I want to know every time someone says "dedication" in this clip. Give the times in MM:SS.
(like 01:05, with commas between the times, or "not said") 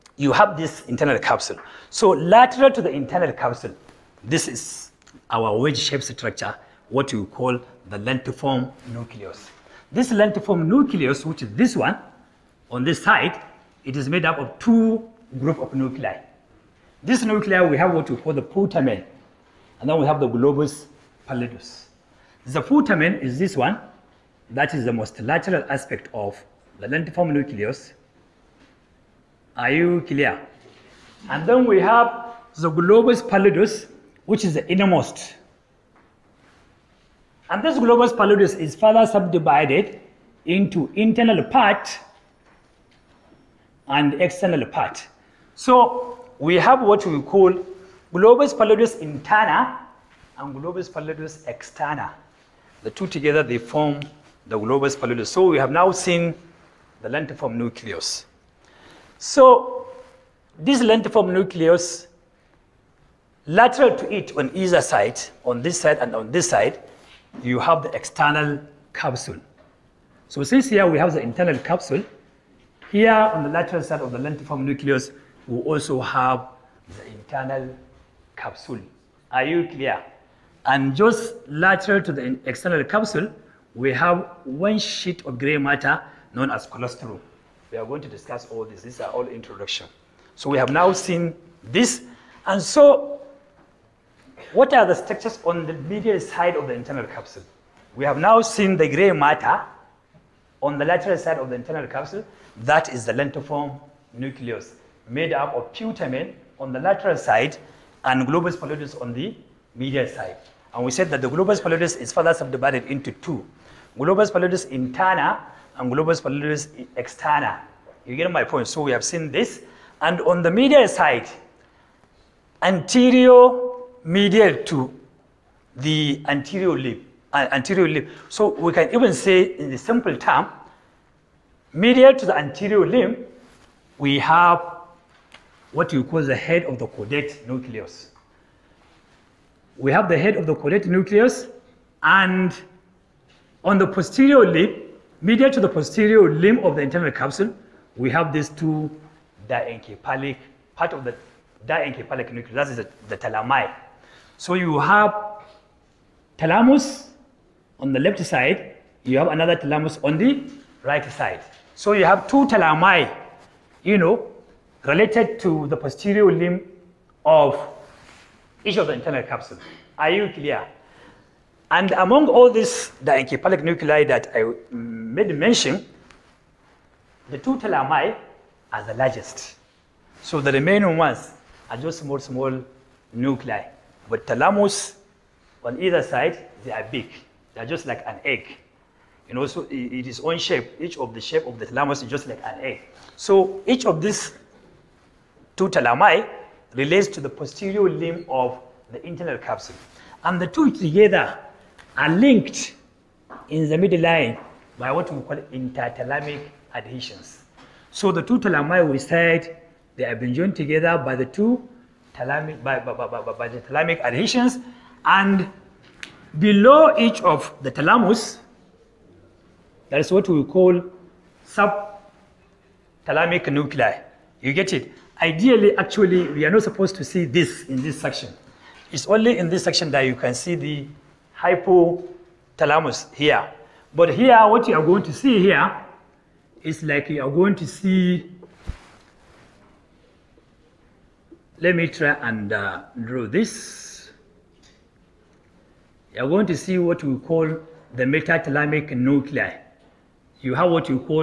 not said.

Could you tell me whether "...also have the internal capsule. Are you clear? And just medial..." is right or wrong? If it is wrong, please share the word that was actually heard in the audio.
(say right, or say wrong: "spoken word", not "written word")
wrong: "lateral", not "medial".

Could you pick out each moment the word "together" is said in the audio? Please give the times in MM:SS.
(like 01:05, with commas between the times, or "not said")
00:53, 03:20, 03:30.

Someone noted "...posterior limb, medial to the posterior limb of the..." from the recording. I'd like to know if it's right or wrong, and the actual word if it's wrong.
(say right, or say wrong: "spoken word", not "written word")
right.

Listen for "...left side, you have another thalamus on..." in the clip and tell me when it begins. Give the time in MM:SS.
02:37.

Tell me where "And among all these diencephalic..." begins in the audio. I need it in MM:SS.
02:51.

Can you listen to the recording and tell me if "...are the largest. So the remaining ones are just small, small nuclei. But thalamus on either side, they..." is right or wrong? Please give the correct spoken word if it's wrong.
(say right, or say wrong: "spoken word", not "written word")
right.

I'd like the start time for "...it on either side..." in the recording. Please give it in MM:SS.
01:04.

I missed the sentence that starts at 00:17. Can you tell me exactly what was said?
This nuclei, we have what we call the putamen, and then we have the globus pallidus.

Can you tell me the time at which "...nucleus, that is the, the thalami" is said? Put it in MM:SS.
02:32.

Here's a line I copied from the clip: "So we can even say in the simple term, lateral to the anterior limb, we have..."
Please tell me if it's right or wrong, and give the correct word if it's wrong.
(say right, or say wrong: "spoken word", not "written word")
wrong: "medial", not "lateral".